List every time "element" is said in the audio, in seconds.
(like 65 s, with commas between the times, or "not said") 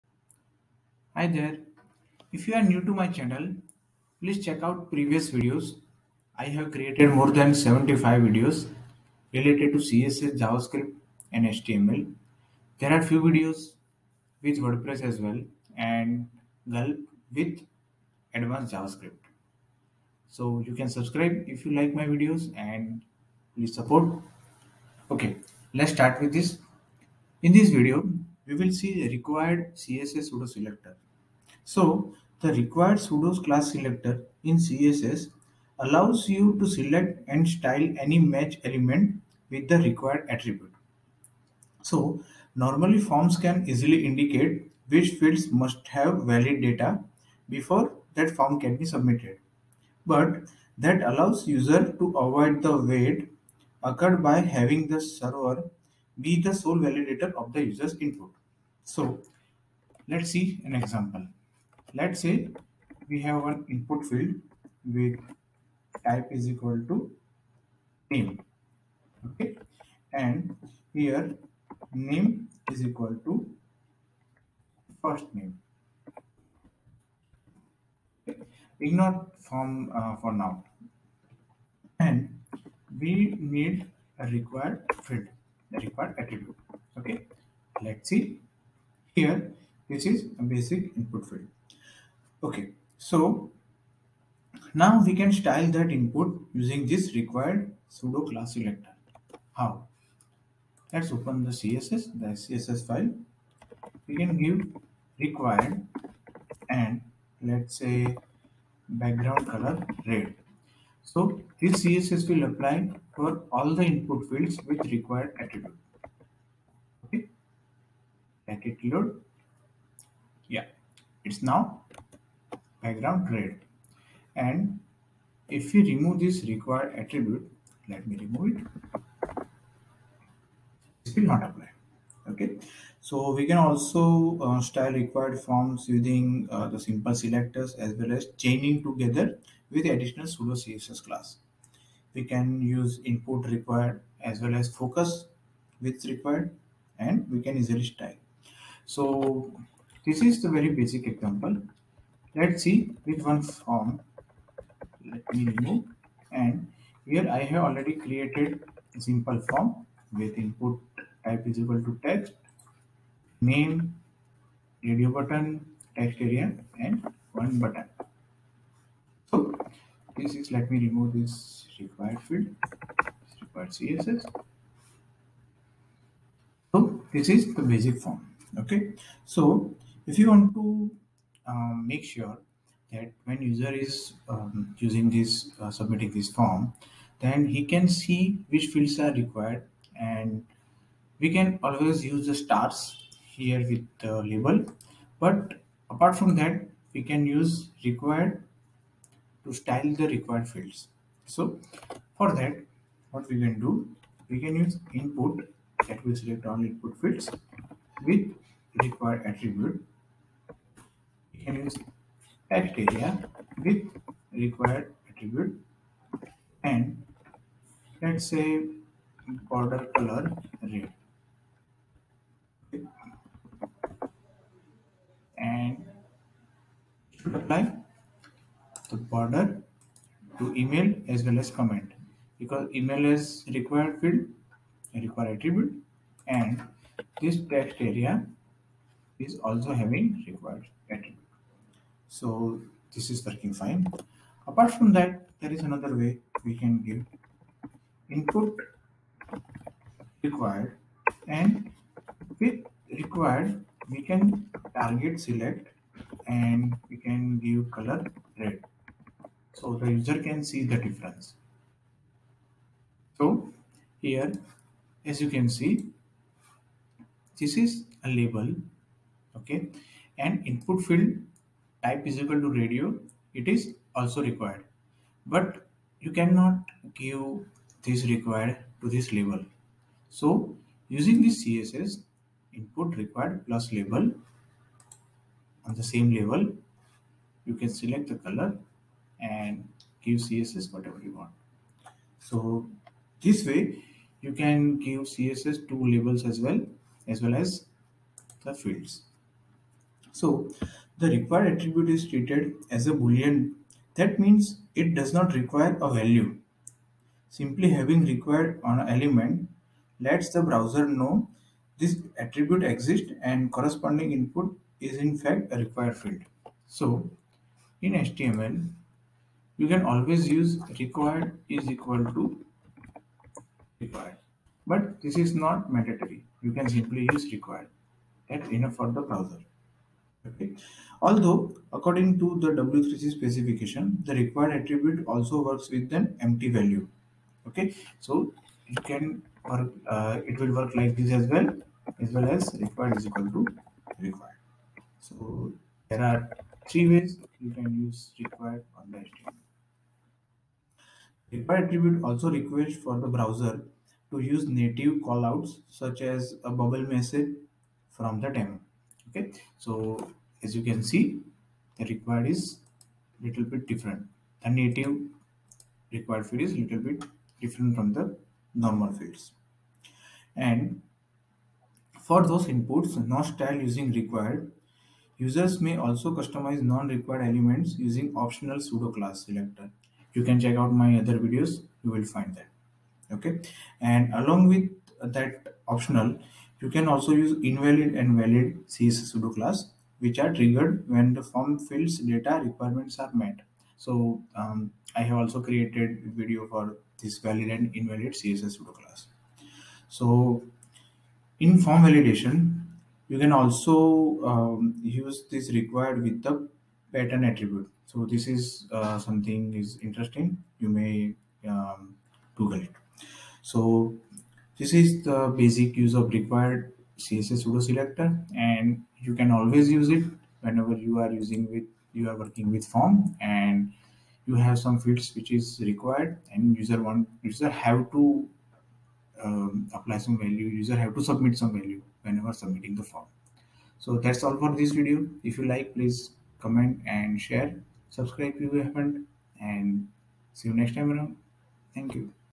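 38 s, 308 s, 377 s.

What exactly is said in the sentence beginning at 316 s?
So in HTML, you can always use required is equal to required.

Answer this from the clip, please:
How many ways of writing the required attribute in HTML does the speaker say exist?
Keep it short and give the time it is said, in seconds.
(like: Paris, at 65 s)
3, at 346 s.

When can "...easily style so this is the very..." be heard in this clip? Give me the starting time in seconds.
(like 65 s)
147 s.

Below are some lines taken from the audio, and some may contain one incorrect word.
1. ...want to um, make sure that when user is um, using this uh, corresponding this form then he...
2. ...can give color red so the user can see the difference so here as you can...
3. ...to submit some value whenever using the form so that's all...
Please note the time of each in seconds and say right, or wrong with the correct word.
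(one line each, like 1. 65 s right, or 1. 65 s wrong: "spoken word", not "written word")
1. 180 s wrong: "submitting", not "corresponding"
2. 256 s right
3. 430 s wrong: "submitting", not "using".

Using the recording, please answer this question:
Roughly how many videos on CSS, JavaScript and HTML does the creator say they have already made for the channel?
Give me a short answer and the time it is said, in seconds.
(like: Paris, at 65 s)
More than 75, at 7 s.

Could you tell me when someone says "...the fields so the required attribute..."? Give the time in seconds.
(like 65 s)
298 s.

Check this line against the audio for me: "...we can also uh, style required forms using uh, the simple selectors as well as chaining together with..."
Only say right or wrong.
right.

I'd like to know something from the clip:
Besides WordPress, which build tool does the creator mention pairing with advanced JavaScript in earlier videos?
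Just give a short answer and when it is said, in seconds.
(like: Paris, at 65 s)
Gulp, at 16 s.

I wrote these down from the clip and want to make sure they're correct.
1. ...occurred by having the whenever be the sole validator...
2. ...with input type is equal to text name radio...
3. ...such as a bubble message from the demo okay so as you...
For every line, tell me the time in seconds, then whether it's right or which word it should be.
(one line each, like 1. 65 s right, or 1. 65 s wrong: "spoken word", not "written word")
1. 53 s wrong: "server", not "whenever"
2. 160 s right
3. 355 s right.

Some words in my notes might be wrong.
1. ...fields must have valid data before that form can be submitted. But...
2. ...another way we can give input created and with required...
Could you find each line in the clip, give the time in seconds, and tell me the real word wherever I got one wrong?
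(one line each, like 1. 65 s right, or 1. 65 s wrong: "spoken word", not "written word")
1. 45 s right
2. 245 s wrong: "required", not "created".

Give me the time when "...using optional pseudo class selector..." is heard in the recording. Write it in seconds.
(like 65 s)
377 s.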